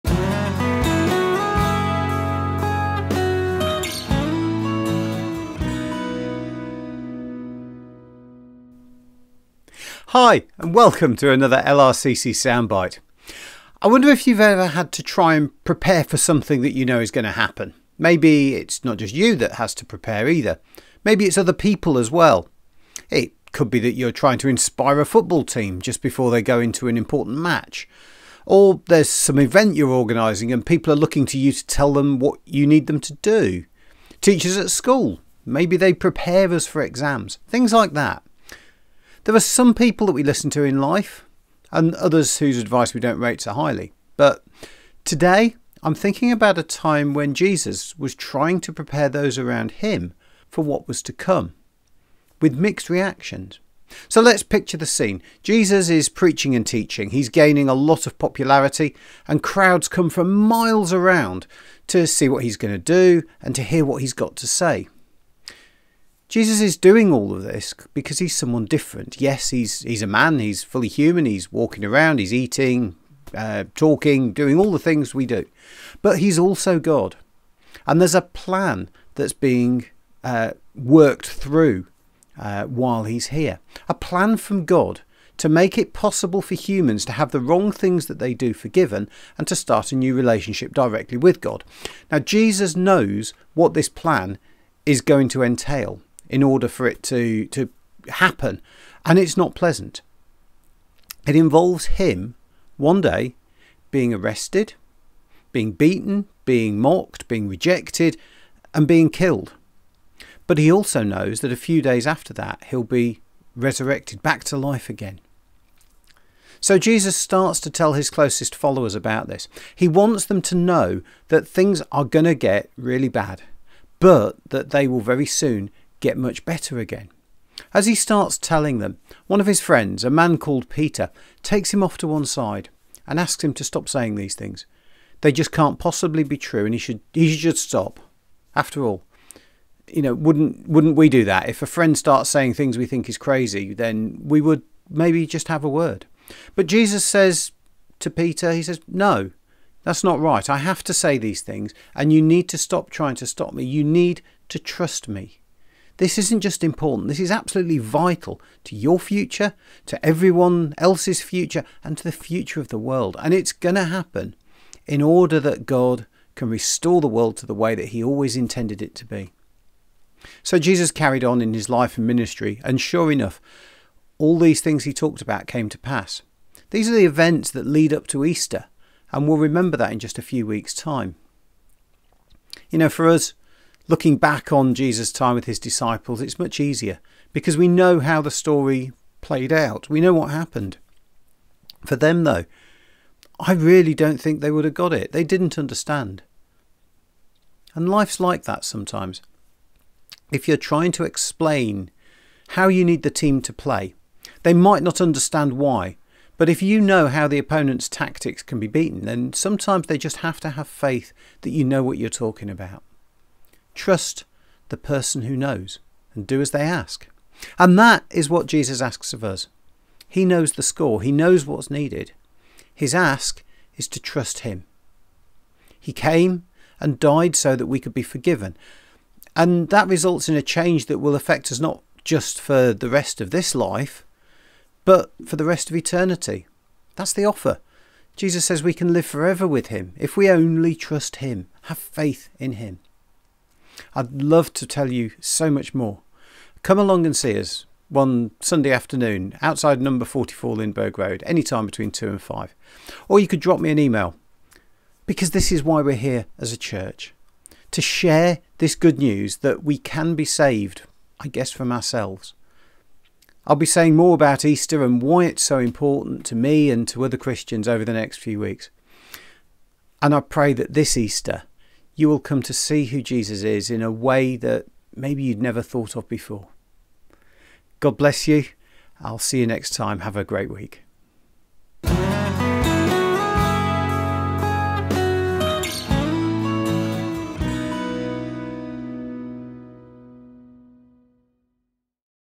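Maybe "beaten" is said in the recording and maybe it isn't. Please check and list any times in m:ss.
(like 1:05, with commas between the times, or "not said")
1:45, 3:28.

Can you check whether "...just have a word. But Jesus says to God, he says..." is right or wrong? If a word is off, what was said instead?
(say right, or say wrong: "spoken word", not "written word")
wrong: "Peter", not "God".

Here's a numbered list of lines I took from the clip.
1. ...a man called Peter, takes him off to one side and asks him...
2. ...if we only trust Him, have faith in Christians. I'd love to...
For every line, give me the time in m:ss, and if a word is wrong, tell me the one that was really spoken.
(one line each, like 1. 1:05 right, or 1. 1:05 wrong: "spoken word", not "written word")
1. 2:10 right
2. 3:59 wrong: "Him", not "Christians".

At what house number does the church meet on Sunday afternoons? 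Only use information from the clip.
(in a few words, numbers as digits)
44.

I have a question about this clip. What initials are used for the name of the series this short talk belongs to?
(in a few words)
LRCC.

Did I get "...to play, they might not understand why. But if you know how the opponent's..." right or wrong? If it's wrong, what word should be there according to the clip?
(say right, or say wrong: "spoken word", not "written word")
right.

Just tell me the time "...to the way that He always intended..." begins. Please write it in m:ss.
2:47.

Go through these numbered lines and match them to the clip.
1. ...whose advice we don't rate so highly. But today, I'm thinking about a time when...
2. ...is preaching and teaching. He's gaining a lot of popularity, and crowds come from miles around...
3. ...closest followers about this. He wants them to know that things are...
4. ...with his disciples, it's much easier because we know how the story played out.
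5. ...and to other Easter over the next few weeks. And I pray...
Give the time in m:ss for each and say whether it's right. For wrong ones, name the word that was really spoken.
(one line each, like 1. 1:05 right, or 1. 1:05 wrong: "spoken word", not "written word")
1. 0:42 right
2. 0:55 right
3. 1:58 right
4. 3:05 right
5. 4:26 wrong: "Christians", not "Easter".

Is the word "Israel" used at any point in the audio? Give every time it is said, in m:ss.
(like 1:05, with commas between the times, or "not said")
not said.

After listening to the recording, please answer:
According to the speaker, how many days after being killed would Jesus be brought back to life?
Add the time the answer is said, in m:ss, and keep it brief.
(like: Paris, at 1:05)
a few days, at 1:51.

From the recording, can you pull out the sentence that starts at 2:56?
These are the events that lead up to Easter, and we'll remember that in just a few weeks' time.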